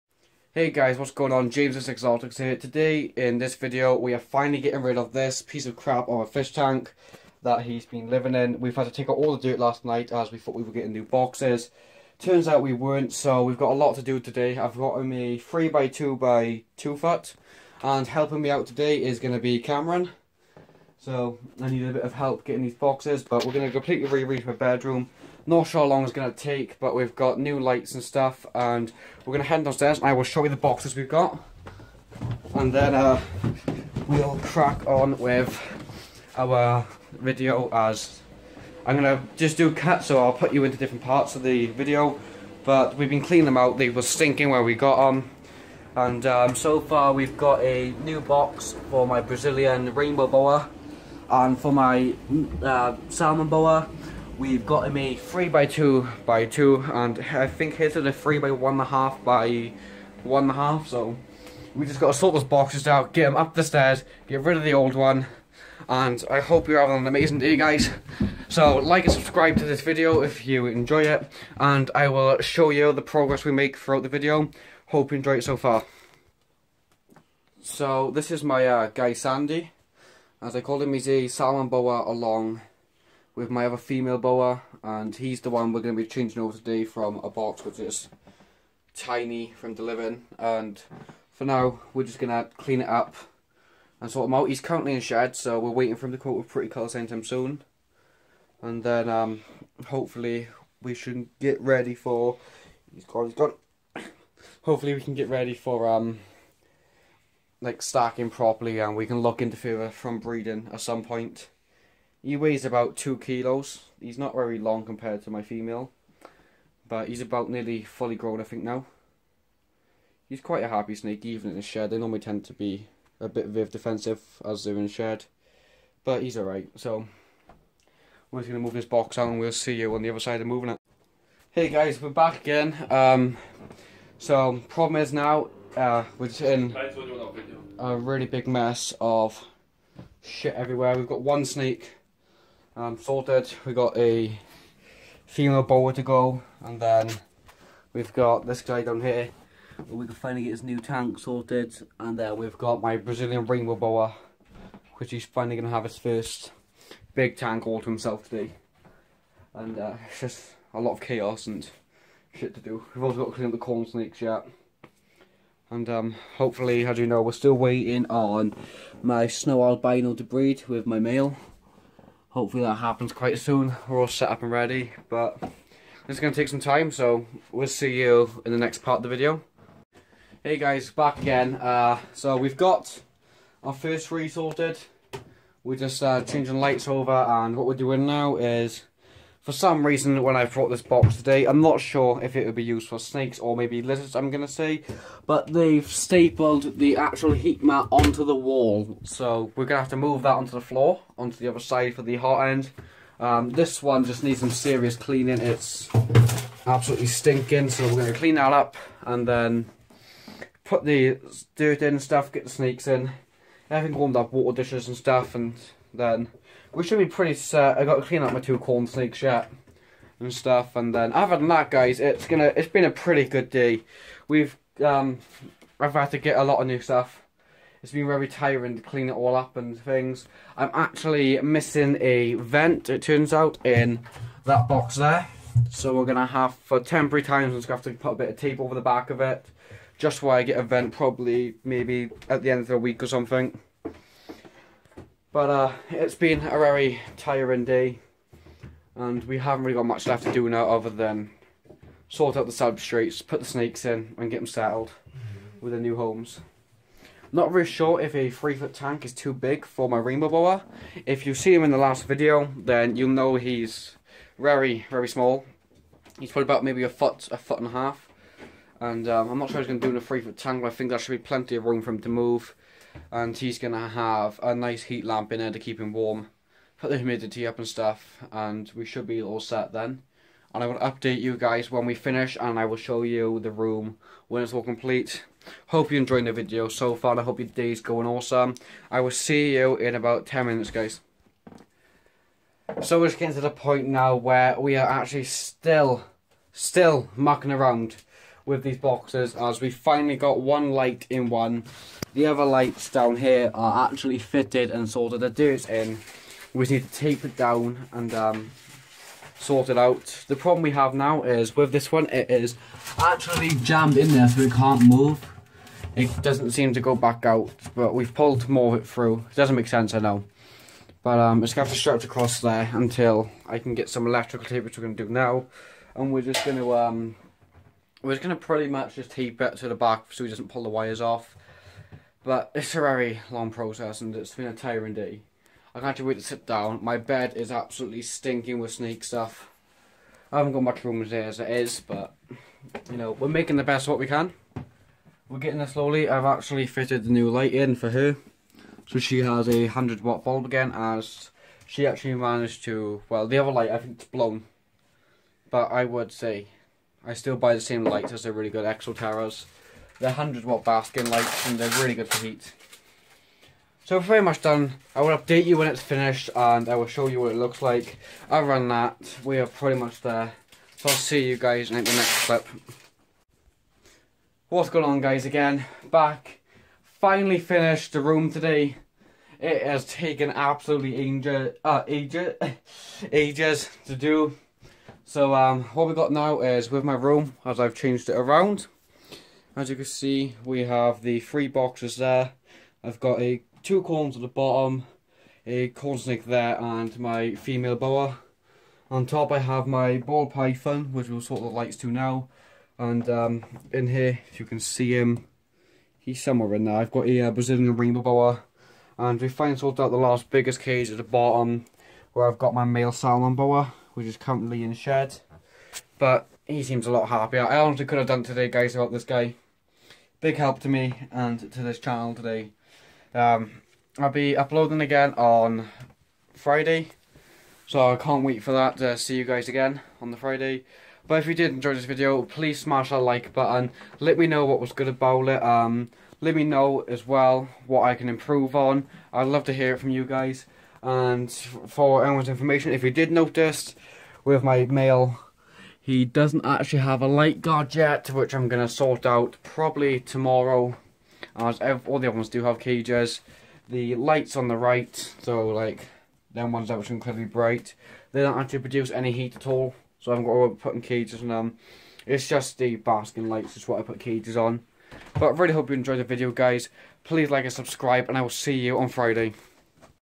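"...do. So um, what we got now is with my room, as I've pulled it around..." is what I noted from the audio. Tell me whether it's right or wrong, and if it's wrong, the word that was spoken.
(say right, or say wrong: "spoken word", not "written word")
wrong: "changed", not "pulled".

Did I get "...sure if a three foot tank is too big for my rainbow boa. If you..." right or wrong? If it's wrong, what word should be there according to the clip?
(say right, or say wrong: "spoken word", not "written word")
right.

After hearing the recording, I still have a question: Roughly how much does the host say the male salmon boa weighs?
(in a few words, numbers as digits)
2 kilos.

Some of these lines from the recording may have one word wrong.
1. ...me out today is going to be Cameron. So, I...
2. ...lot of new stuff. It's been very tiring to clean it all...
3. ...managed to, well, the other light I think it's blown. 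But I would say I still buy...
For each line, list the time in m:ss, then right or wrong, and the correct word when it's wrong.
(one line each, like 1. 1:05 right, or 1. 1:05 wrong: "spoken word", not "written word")
1. 0:18 right
2. 3:46 right
3. 5:52 right.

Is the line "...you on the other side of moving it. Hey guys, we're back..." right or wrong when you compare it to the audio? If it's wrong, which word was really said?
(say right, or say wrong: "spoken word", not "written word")
right.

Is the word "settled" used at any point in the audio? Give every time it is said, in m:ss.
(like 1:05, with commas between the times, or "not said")
4:14.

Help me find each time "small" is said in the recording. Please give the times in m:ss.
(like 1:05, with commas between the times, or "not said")
4:25.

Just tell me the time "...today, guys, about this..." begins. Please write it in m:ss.
6:58.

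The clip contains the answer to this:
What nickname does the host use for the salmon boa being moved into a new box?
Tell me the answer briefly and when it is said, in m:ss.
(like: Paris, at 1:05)
Sandy, at 1:19.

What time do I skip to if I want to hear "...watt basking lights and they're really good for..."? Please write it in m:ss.
6:00.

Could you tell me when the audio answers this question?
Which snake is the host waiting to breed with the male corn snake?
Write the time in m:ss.
2:49.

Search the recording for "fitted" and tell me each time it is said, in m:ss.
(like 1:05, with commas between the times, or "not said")
5:04, 5:46.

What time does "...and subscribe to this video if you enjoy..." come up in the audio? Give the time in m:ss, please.
1:09.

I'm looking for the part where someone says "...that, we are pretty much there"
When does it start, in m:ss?
6:08.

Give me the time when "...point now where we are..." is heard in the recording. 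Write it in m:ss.
4:53.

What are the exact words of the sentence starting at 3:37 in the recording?
I got to clean up my two corn snakes yet and stuff.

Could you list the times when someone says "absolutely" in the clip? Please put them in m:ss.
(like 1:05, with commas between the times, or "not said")
3:26, 5:37, 6:20.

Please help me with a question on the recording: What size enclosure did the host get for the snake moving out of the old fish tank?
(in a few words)
3x2 by 2 foot.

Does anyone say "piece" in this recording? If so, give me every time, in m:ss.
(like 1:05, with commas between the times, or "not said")
0:05.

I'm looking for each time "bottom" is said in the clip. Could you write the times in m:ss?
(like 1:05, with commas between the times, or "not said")
6:34, 6:51.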